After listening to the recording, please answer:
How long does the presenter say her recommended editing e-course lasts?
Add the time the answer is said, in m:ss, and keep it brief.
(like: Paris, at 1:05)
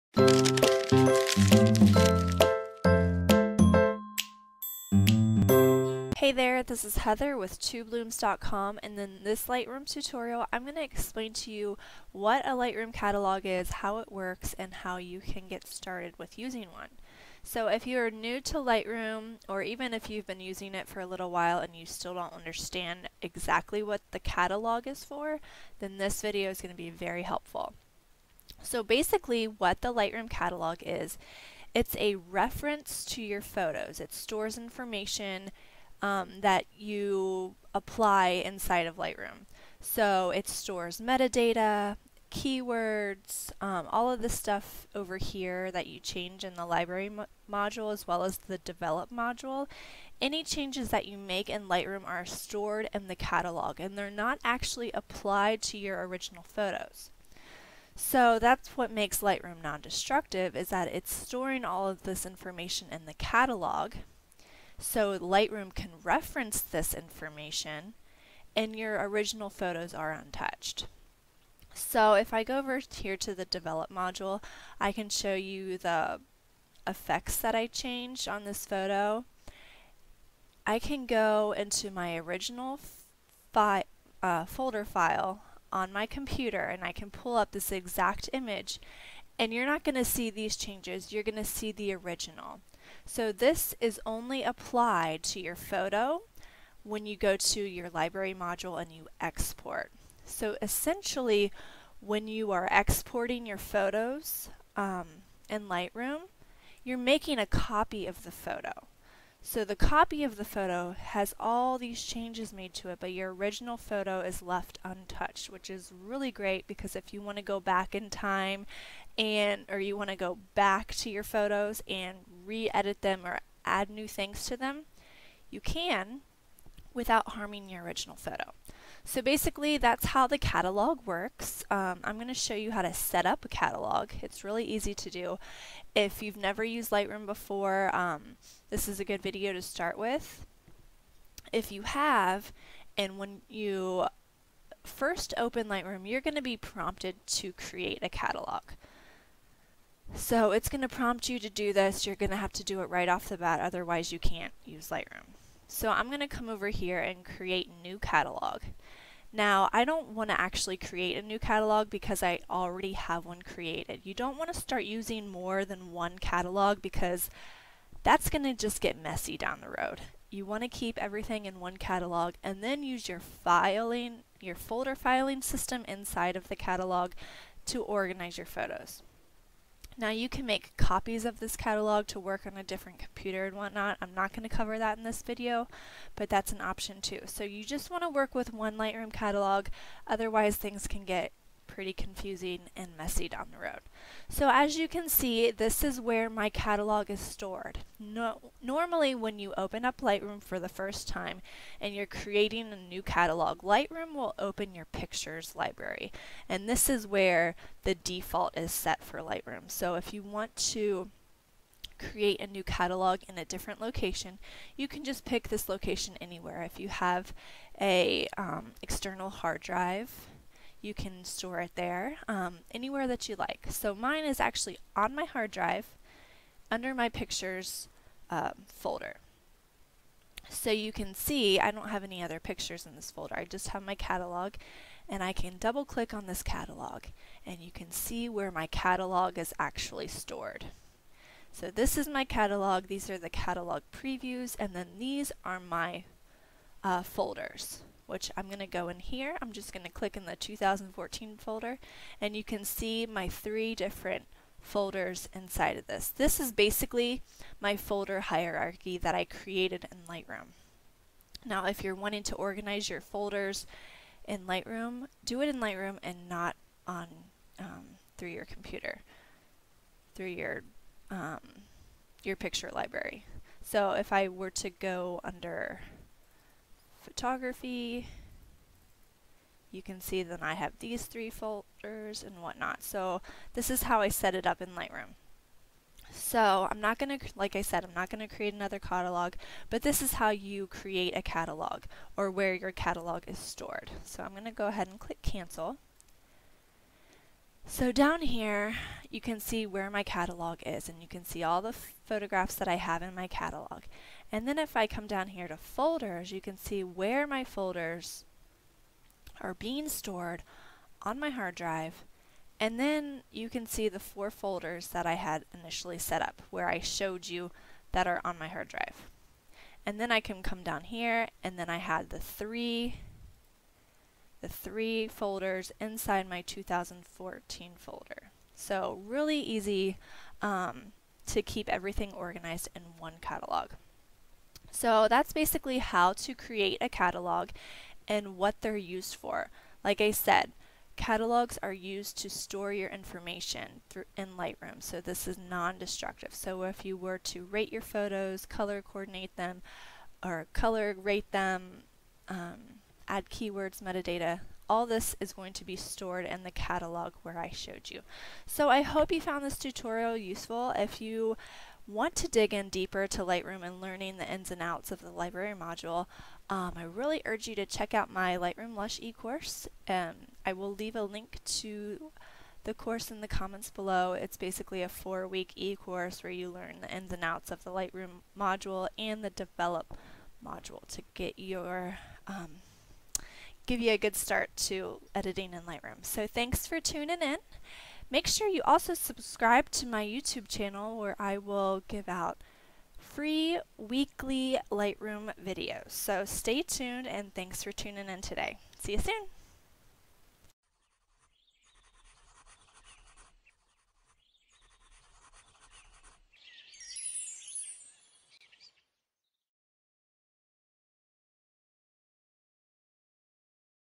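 4 weeks, at 6:14.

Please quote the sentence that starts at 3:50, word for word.
So you can see I don't have any other pictures in this folder.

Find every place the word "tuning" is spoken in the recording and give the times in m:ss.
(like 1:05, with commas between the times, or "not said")
6:26, 6:37.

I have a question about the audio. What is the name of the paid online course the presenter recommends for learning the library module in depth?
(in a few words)
Lightroom Lush.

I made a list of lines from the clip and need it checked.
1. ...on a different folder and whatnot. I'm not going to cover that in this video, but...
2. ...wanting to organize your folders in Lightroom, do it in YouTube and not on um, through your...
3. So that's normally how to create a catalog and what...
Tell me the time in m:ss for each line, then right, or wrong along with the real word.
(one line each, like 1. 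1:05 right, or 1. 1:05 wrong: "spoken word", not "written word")
1. 3:02 wrong: "computer", not "folder"
2. 4:21 wrong: "Lightroom", not "YouTube"
3. 5:34 wrong: "basically", not "normally".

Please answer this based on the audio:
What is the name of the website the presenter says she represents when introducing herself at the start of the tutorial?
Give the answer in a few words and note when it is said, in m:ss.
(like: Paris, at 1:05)
TwoBlooms.com, at 0:07.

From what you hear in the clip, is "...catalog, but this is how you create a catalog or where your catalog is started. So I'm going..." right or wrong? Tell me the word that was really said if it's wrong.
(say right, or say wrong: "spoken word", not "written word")
wrong: "stored", not "started".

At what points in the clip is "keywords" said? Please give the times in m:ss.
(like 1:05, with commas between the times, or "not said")
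0:42, 5:53.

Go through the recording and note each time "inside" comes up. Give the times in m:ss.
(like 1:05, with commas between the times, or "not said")
0:38, 2:55, 4:15, 5:25.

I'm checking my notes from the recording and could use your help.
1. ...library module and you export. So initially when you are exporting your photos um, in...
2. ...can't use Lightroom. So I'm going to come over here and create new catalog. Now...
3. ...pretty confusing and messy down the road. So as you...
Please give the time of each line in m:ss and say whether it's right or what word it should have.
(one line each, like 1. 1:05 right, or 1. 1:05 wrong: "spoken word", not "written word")
1. 1:37 wrong: "essentially", not "initially"
2. 2:34 right
3. 3:11 right.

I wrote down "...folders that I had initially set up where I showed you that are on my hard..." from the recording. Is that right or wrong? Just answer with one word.
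right.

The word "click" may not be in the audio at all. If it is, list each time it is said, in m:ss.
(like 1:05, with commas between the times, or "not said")
3:55, 4:09, 4:54.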